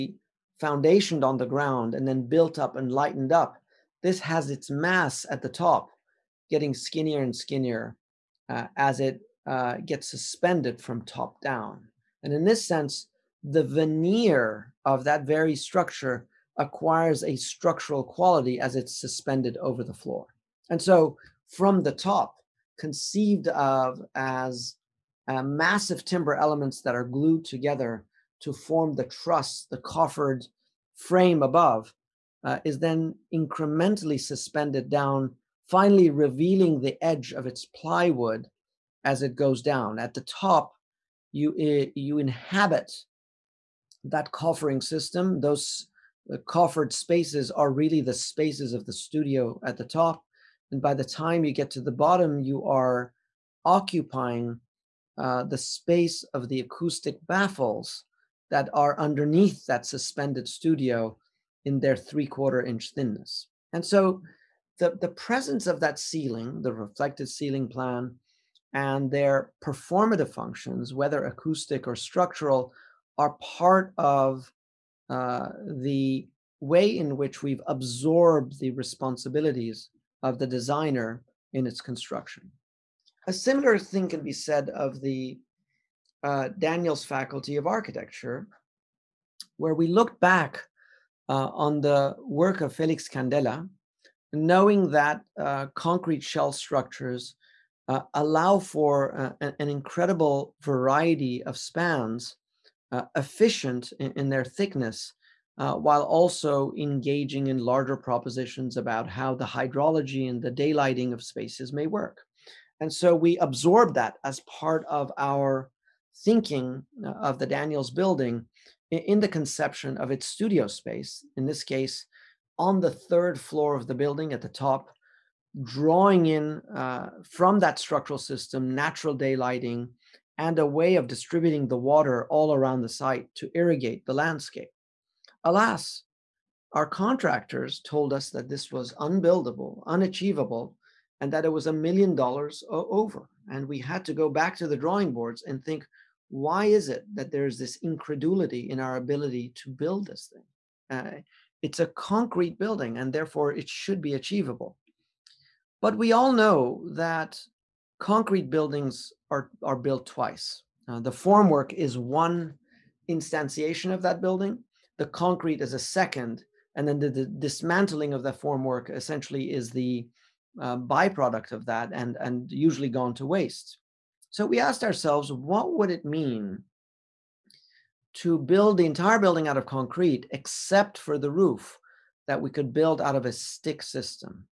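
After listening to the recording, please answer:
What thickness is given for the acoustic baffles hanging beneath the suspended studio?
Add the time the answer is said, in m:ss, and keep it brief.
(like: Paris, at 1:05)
3/4 inch, at 1:01.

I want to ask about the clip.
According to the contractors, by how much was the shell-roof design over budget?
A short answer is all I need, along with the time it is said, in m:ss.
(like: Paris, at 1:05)
$1 million, at 2:21.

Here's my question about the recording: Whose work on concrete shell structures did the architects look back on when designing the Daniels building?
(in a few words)
Felix Candela.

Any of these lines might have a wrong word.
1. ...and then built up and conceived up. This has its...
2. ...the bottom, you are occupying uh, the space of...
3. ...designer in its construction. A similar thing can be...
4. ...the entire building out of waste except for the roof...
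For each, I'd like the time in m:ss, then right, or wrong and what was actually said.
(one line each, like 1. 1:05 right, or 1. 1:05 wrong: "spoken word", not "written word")
1. 0:01 wrong: "lightened", not "conceived"
2. 0:51 right
3. 1:20 right
4. 2:58 wrong: "concrete", not "waste".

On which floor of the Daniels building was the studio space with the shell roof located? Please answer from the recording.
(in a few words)
Third floor.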